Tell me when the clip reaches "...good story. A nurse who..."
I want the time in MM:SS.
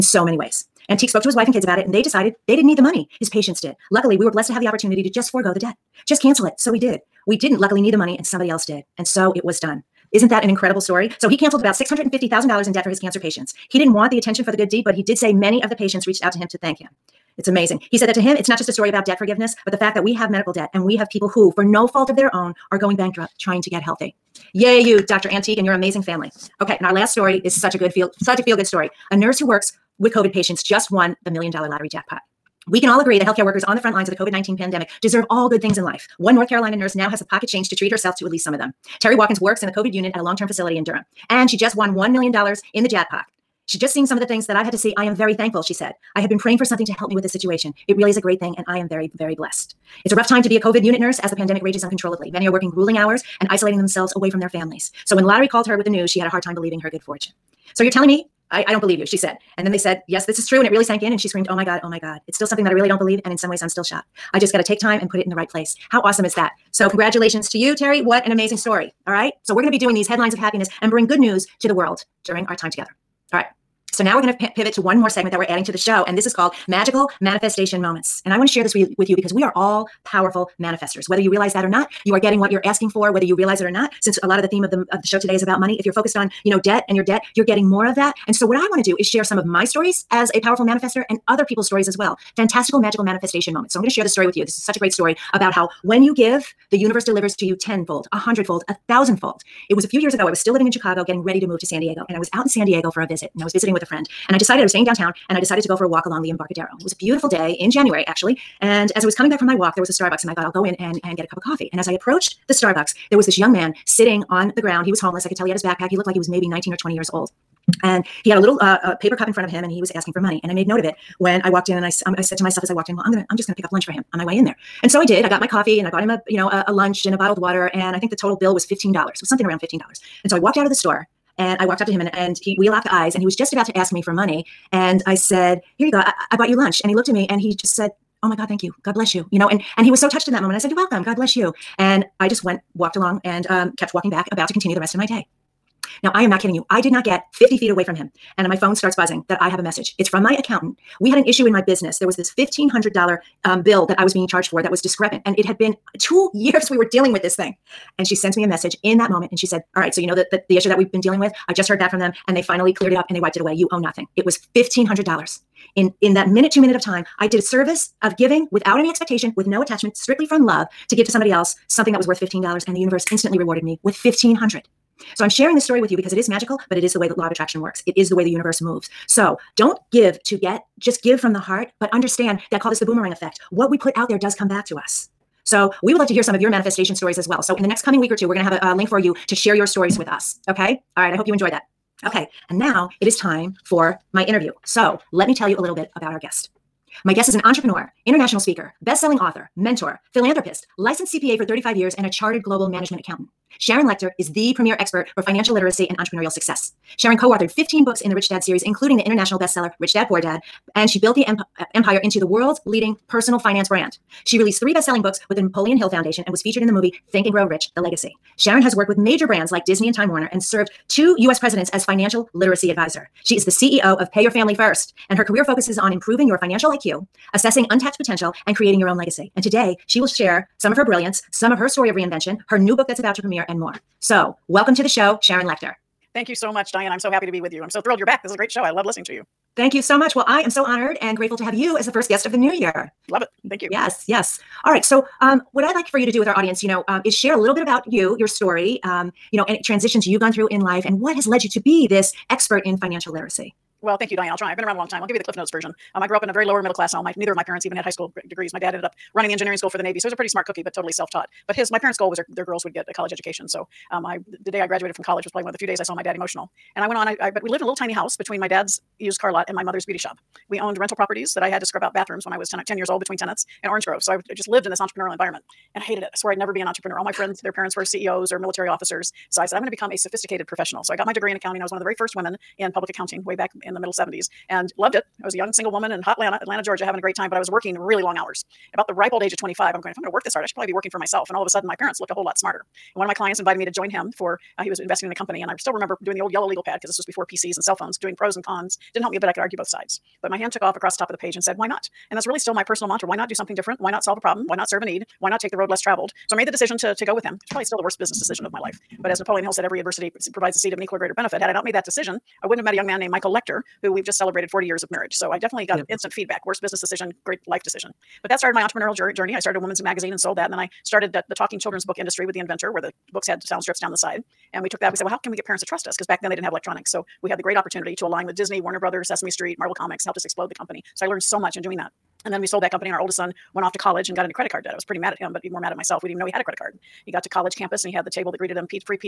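00:28.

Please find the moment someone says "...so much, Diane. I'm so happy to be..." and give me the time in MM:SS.
03:56.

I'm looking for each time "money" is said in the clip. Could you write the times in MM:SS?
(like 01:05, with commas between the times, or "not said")
00:02, 00:07, 01:25, 02:00, 02:14.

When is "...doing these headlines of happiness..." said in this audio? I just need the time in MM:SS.
01:09.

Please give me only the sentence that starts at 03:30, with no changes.
And she built the empire empire into the world's leading personal finance brand.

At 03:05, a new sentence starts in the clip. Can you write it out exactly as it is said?
So we would love to hear some of your manifestation stories as well.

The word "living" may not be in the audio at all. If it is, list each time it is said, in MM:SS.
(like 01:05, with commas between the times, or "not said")
01:40.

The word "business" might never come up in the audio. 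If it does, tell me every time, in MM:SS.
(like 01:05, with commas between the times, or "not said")
02:31, 05:07, 05:16.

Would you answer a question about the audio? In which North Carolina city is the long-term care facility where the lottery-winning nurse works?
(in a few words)
Durham.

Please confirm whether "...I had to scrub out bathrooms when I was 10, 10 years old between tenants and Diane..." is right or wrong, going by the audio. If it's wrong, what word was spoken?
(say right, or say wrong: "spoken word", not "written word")
wrong: "Orange", not "Diane".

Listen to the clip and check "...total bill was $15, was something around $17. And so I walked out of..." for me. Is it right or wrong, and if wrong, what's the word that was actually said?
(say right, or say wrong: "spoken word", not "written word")
wrong: "15", not "17".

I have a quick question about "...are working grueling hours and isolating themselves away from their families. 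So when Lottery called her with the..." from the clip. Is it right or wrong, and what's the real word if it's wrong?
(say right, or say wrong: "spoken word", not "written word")
right.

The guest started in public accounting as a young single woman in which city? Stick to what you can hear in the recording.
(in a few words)
Atlanta.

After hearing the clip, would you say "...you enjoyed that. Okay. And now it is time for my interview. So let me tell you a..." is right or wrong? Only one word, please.
right.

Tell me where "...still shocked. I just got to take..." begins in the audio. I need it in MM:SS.
01:03.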